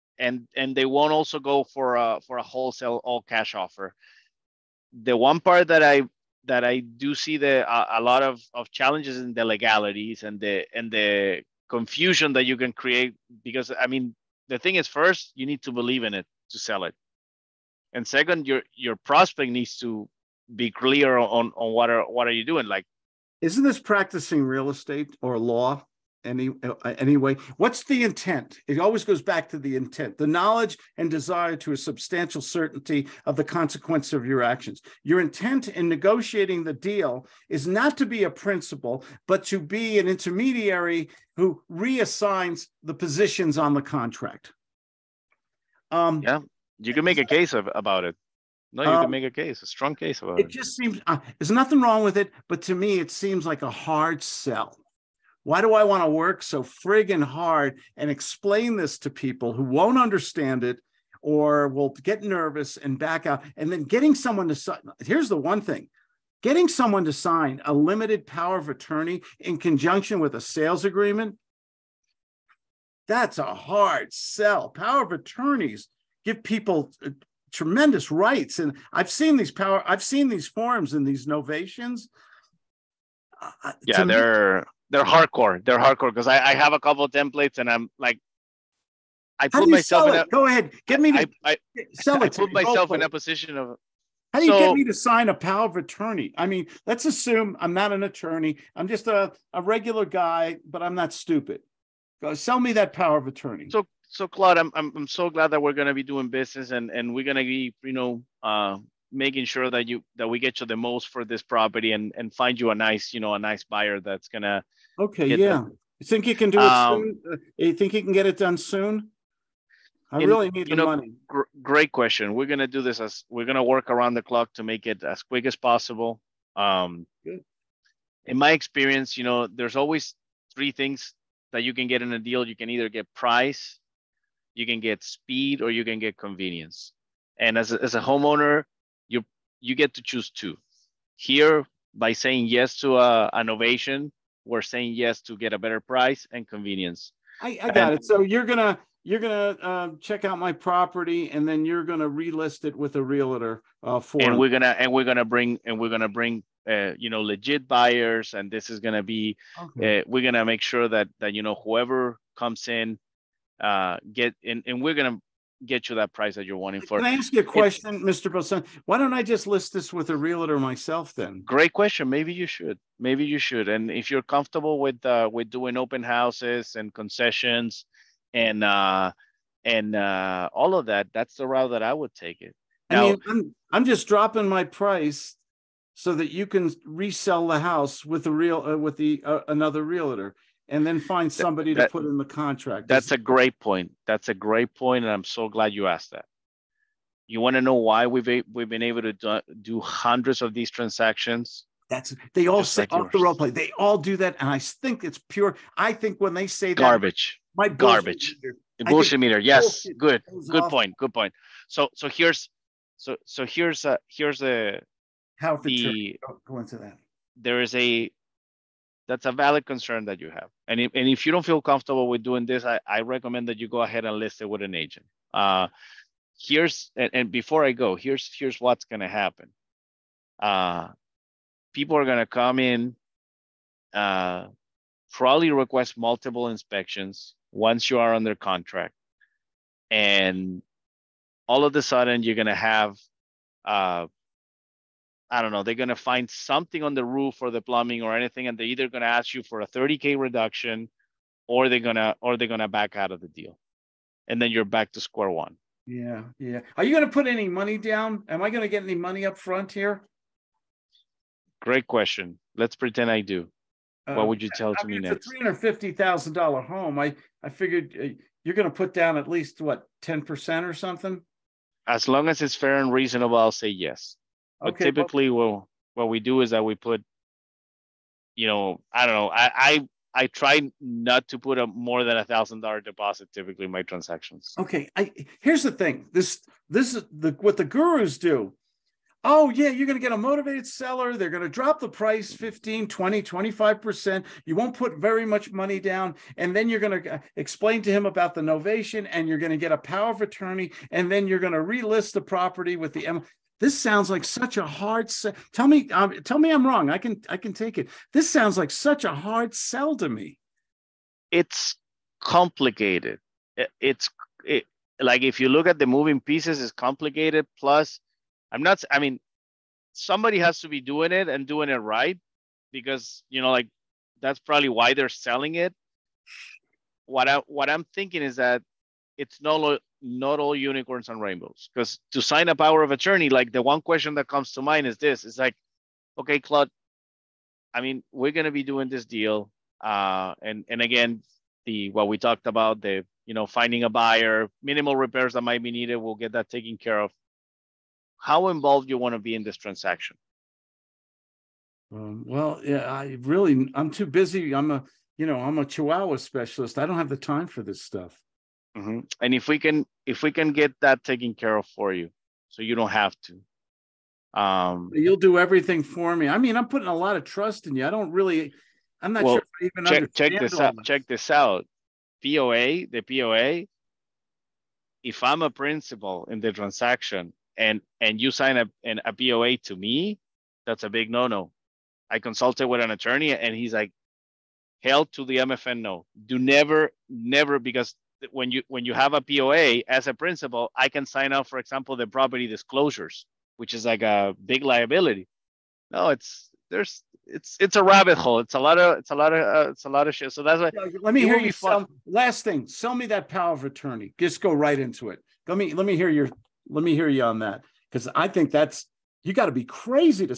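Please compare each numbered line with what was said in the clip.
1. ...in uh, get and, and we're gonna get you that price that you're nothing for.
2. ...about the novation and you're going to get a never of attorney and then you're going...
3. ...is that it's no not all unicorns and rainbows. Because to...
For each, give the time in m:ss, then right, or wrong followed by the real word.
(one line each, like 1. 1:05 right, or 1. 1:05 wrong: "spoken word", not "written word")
1. 2:42 wrong: "wanting", not "nothing"
2. 4:58 wrong: "power", not "never"
3. 5:28 right.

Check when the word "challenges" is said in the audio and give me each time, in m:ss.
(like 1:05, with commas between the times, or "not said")
0:08.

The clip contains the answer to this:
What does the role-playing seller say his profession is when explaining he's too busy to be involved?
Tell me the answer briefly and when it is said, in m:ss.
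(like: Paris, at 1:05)
Chihuahua specialist, at 5:55.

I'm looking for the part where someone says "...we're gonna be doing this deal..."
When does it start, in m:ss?
5:38.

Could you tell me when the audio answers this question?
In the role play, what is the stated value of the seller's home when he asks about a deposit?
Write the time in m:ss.
4:25.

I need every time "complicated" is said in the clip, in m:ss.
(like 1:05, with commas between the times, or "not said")
5:12, 5:16.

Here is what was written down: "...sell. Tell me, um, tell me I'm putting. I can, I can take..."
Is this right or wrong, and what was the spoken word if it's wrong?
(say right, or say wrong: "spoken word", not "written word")
wrong: "wrong", not "putting".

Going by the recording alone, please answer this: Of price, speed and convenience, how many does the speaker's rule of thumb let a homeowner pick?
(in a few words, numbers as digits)
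2.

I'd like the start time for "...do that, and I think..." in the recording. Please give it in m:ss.
3:23.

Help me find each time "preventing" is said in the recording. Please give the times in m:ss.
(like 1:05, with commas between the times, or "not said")
not said.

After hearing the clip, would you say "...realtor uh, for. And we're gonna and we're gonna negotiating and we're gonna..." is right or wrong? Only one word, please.
wrong.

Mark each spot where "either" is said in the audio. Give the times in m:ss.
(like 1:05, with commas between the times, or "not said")
2:12, 4:08.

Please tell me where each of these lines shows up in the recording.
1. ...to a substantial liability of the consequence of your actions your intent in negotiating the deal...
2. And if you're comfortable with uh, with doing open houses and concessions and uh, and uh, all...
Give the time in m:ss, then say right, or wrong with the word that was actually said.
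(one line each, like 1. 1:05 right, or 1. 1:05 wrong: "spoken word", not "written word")
1. 0:31 wrong: "certainty", not "liability"
2. 2:53 right.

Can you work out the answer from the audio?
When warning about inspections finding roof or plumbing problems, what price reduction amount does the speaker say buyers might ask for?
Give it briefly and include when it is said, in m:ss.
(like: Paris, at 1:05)
30k, at 4:09.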